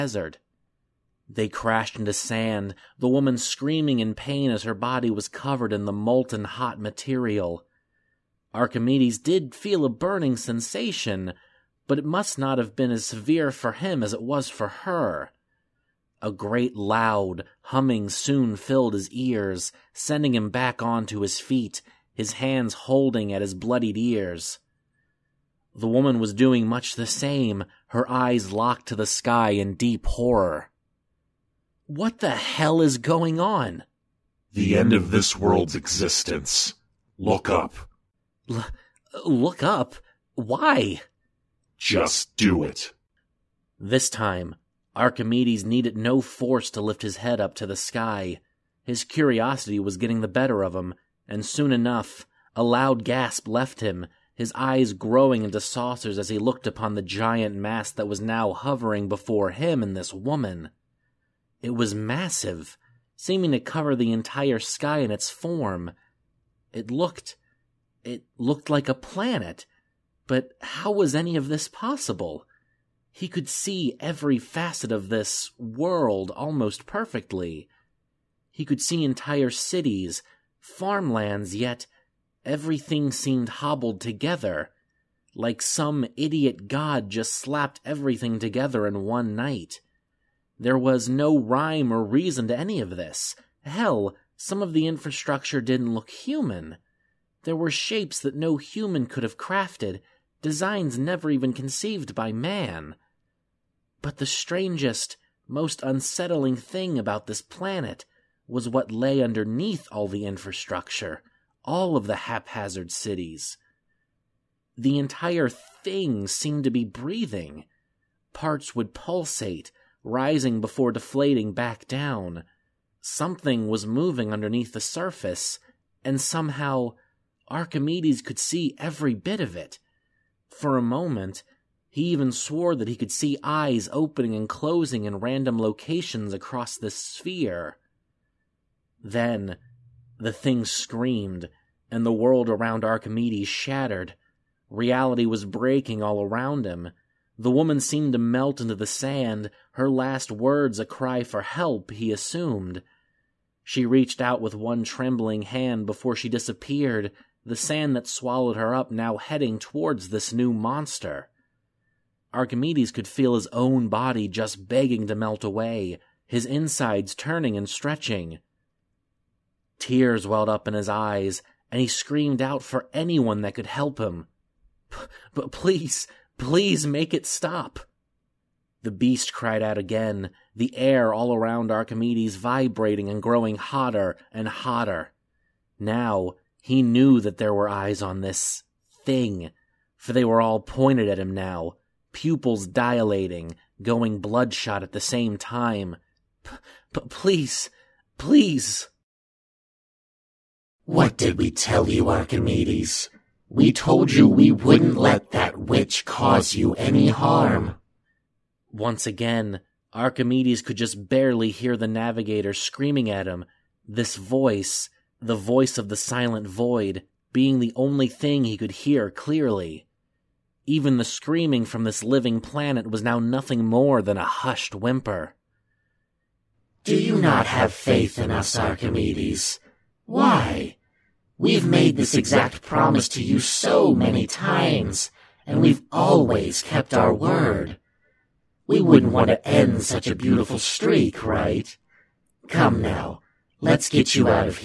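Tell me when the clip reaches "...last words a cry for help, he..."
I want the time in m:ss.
2:29.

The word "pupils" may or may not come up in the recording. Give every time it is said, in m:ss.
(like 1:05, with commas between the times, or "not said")
3:12.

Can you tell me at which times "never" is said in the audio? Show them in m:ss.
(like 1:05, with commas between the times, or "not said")
1:40.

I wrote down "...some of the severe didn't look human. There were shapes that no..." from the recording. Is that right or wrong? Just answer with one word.
wrong.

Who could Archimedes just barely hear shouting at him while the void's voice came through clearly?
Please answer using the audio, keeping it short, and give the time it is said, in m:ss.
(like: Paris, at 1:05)
the navigator, at 3:31.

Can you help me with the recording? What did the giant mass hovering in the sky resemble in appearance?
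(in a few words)
a planet.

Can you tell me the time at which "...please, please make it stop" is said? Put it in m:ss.
2:55.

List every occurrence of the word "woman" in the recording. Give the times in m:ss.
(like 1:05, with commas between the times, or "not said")
0:03, 0:25, 1:00, 2:27.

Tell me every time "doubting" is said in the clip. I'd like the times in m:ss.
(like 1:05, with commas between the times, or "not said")
not said.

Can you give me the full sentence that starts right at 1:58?
Parts would pulsate, rising before deflating back down.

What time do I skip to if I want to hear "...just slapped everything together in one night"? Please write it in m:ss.
1:27.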